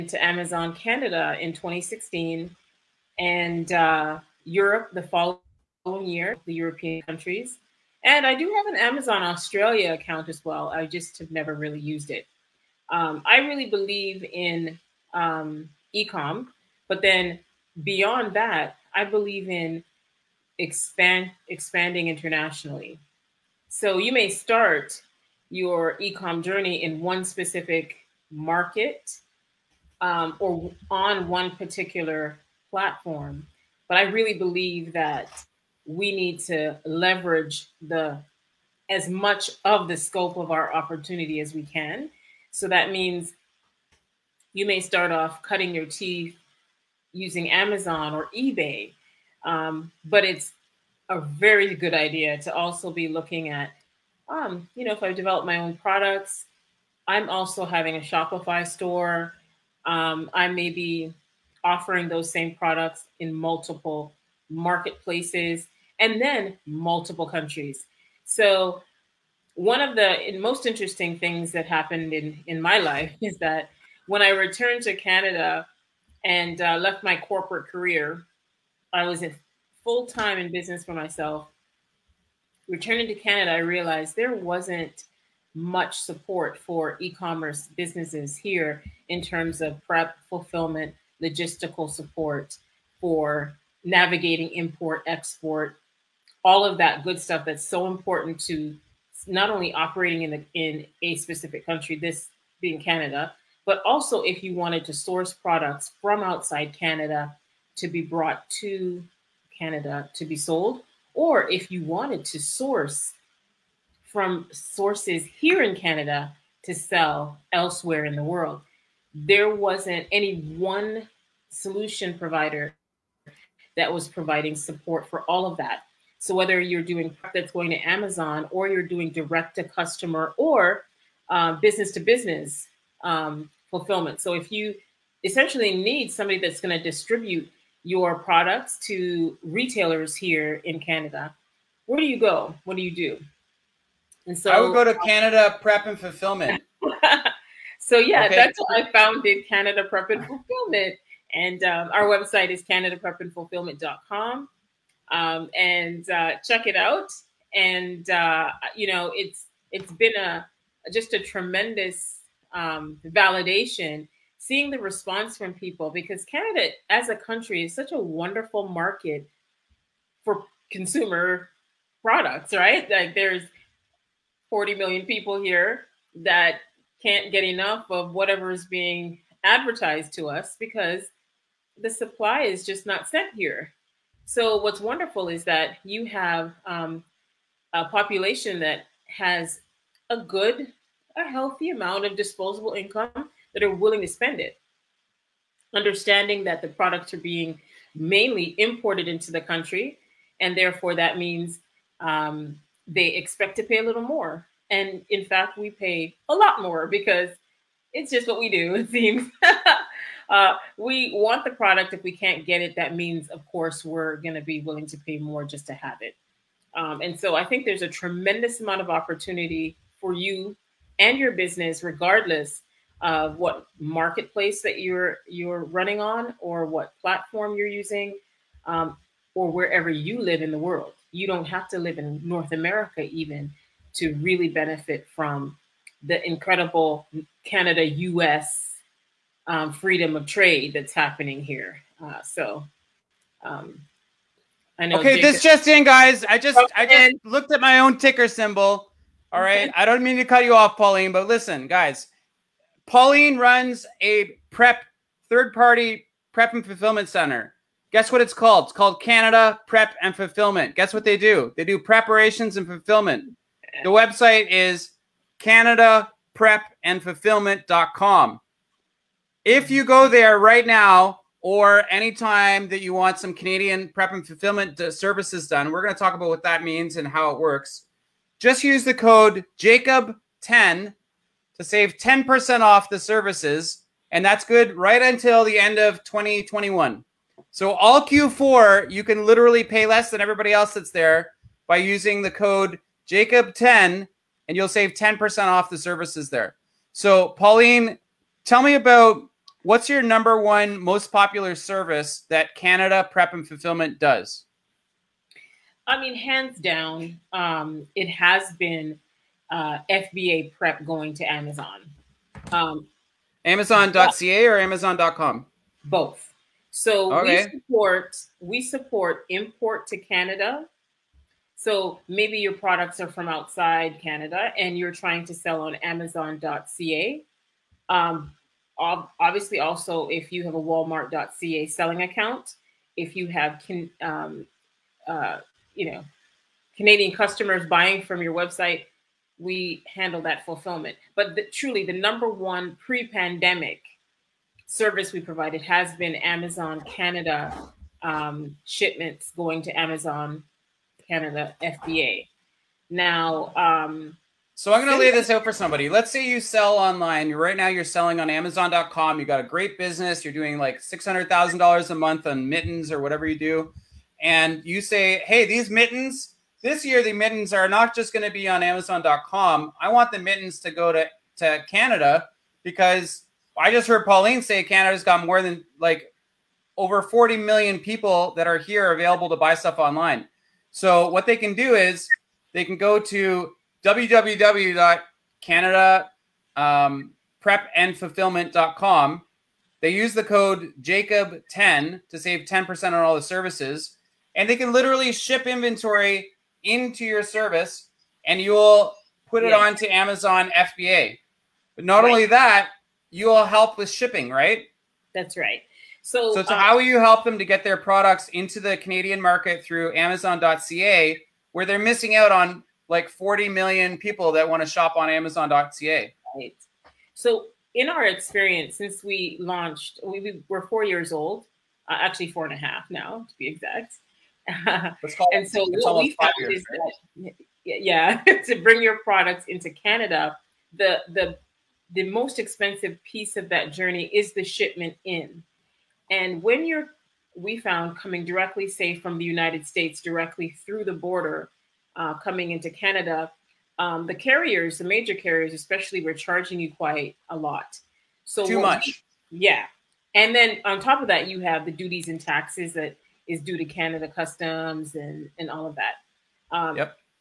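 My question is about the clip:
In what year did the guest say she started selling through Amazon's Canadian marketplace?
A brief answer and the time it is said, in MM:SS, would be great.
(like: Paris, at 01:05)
2016, at 00:01.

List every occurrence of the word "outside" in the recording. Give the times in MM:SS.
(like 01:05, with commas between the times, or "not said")
01:46, 05:23.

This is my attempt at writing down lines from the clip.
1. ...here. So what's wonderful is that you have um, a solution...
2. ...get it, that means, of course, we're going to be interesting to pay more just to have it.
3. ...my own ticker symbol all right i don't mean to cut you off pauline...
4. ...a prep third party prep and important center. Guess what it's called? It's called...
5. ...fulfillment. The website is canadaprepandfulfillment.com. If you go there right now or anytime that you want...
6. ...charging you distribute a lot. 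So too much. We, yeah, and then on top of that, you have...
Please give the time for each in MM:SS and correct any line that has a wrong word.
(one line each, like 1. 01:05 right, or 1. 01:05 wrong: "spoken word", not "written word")
1. 03:03 wrong: "population", not "solution"
2. 03:32 wrong: "willing", not "interesting"
3. 04:07 right
4. 04:14 wrong: "fulfillment", not "important"
5. 04:22 right
6. 07:26 wrong: "quite", not "distribute".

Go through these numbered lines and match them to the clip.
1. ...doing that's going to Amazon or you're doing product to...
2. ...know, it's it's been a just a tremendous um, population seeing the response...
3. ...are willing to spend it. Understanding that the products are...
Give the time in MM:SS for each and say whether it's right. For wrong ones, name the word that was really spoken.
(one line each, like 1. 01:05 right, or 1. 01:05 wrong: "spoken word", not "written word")
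1. 02:06 wrong: "direct", not "product"
2. 02:38 wrong: "validation", not "population"
3. 03:13 right.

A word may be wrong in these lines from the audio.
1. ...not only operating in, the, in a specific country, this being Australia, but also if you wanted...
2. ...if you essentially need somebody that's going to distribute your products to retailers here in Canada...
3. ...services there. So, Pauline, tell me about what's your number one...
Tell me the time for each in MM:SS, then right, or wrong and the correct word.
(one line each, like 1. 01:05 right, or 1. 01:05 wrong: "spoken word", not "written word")
1. 01:39 wrong: "Canada", not "Australia"
2. 02:14 right
3. 04:55 right.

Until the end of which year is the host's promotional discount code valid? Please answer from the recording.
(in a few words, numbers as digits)
2021.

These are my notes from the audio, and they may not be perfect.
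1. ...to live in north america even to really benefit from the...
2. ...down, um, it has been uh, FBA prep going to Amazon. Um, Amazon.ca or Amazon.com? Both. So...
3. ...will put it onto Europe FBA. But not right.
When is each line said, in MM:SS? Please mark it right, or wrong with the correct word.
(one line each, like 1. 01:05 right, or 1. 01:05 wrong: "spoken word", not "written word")
1. 03:51 right
2. 05:06 right
3. 06:38 wrong: "Amazon", not "Europe".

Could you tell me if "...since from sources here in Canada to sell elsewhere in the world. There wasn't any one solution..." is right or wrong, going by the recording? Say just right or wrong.
wrong.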